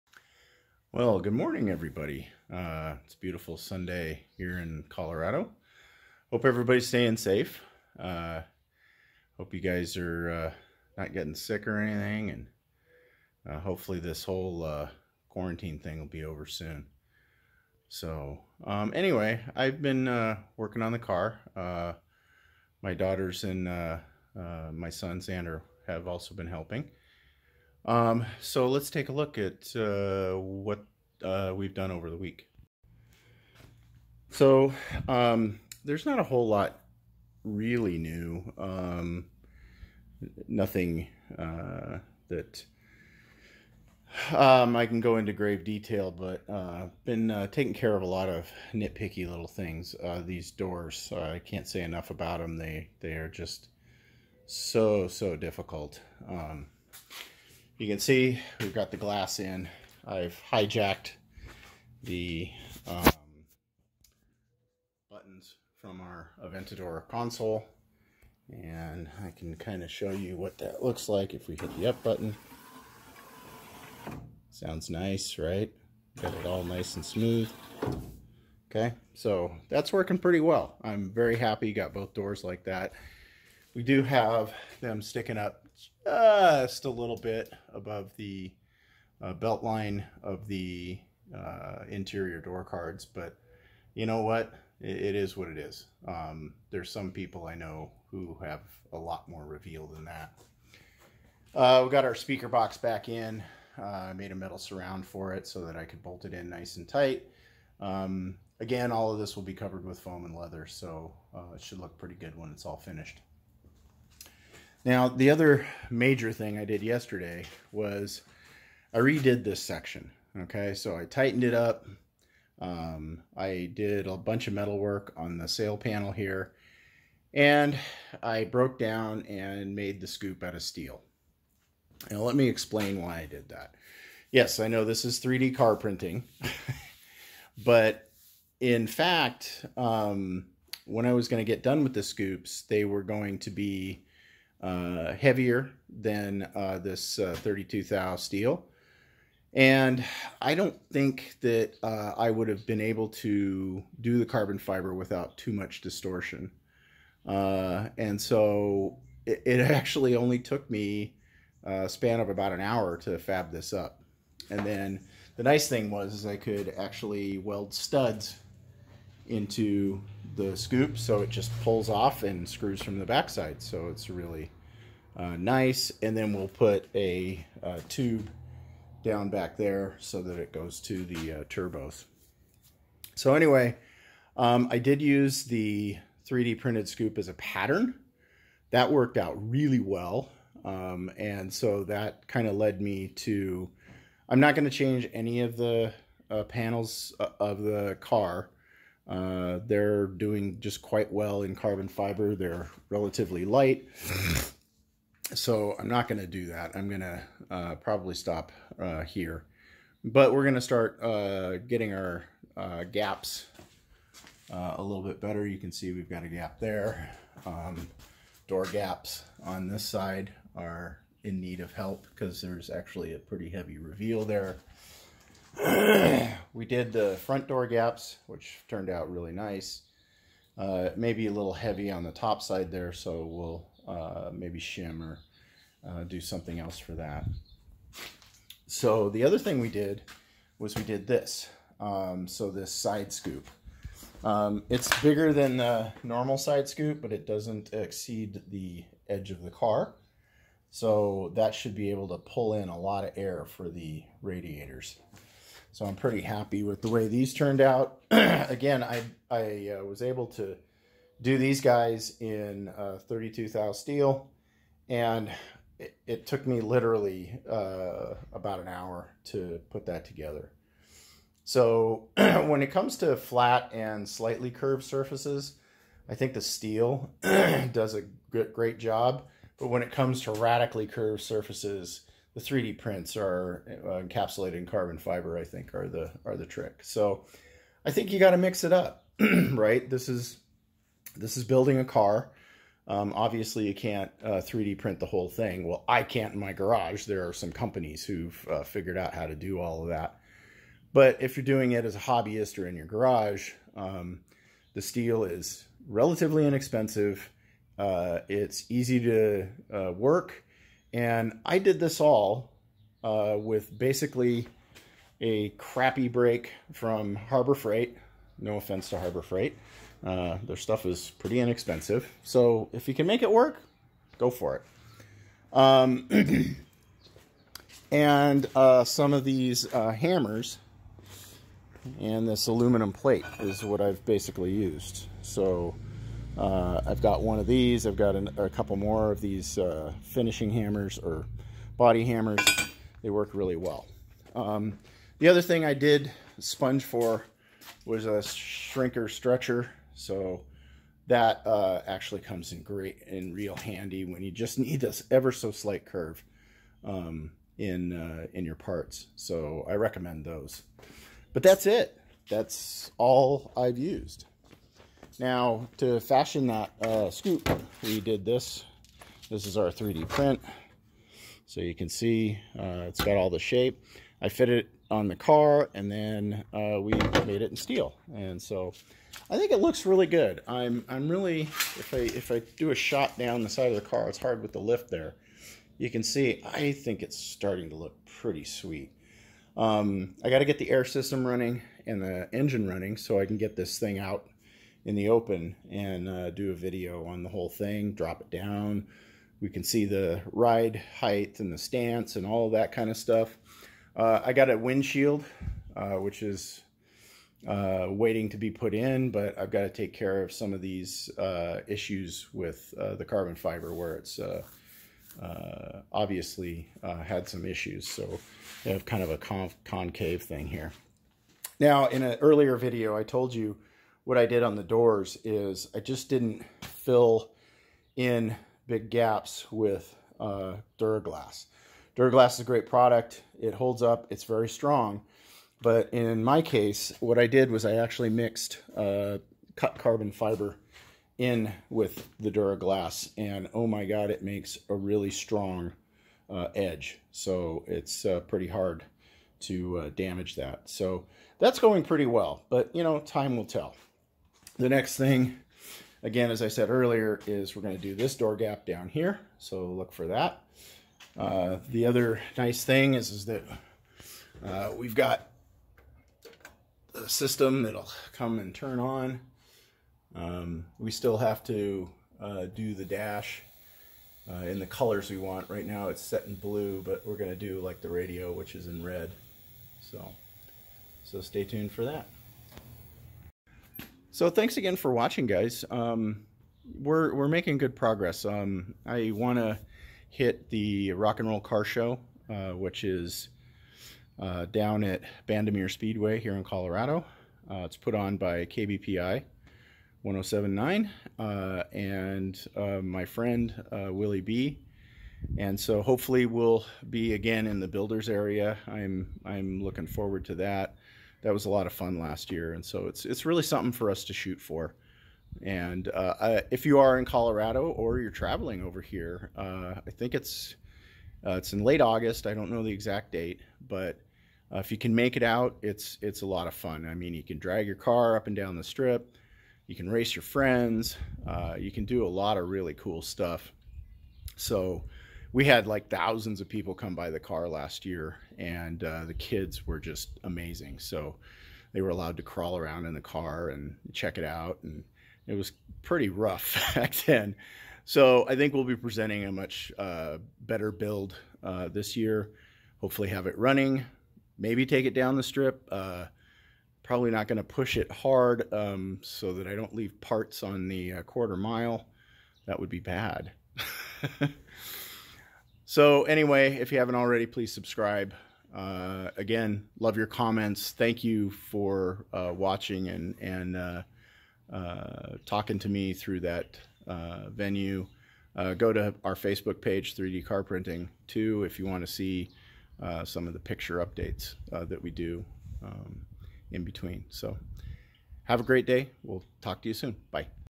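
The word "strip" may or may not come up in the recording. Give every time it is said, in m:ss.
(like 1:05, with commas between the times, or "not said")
8:48, 9:15.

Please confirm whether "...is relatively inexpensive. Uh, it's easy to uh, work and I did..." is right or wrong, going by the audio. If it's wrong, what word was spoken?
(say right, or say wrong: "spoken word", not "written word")
right.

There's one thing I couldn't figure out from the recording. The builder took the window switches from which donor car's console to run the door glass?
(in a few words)
Aventador.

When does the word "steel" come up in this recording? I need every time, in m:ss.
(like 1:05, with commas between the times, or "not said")
2:10, 2:28, 4:23, 4:36, 5:04, 6:17.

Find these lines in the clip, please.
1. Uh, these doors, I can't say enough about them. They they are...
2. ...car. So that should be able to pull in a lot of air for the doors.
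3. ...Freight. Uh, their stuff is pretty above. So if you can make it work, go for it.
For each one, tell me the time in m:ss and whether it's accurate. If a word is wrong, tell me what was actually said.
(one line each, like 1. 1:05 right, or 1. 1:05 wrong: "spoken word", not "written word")
1. 0:50 right
2. 4:09 wrong: "radiators", not "doors"
3. 5:19 wrong: "inexpensive", not "above".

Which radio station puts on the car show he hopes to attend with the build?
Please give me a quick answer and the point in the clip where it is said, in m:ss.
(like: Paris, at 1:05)
KBPI 1079, at 8:18.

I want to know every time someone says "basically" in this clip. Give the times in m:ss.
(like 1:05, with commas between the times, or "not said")
5:13, 5:34.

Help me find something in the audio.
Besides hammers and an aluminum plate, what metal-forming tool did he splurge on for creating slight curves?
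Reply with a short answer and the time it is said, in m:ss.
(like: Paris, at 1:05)
shrinker stretcher, at 5:48.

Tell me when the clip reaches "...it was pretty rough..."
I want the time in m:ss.
9:05.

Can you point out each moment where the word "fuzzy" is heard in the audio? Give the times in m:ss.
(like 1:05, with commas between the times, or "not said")
not said.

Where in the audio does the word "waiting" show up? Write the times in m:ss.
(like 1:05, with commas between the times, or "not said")
6:47.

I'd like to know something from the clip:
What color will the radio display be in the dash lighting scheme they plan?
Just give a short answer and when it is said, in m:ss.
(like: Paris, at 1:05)
red, at 7:58.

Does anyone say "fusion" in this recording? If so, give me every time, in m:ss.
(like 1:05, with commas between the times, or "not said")
not said.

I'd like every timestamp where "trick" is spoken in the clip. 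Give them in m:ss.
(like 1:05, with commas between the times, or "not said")
4:46.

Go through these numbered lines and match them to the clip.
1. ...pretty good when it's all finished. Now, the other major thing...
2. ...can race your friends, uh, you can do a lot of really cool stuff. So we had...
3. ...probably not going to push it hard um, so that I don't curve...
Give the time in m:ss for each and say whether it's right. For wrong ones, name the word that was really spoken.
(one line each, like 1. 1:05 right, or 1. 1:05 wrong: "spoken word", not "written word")
1. 1:51 right
2. 8:49 right
3. 9:16 wrong: "leave", not "curve".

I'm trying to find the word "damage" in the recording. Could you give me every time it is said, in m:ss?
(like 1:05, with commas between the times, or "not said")
7:29.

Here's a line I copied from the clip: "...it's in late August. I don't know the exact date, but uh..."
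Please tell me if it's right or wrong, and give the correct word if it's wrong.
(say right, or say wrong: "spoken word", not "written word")
right.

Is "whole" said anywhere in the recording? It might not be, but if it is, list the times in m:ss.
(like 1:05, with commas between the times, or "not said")
0:14, 0:36, 4:55, 6:37.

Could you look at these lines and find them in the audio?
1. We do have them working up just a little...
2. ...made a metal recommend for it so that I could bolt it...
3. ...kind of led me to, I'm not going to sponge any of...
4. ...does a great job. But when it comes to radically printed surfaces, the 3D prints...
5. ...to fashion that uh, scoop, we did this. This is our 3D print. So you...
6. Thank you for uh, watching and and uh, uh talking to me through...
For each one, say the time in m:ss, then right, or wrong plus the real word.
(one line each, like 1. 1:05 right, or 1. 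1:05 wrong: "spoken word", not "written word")
1. 1:23 wrong: "sticking", not "working"
2. 1:44 wrong: "surround", not "recommend"
3. 3:12 wrong: "change", not "sponge"
4. 4:37 wrong: "curved", not "printed"
5. 6:05 right
6. 9:30 right.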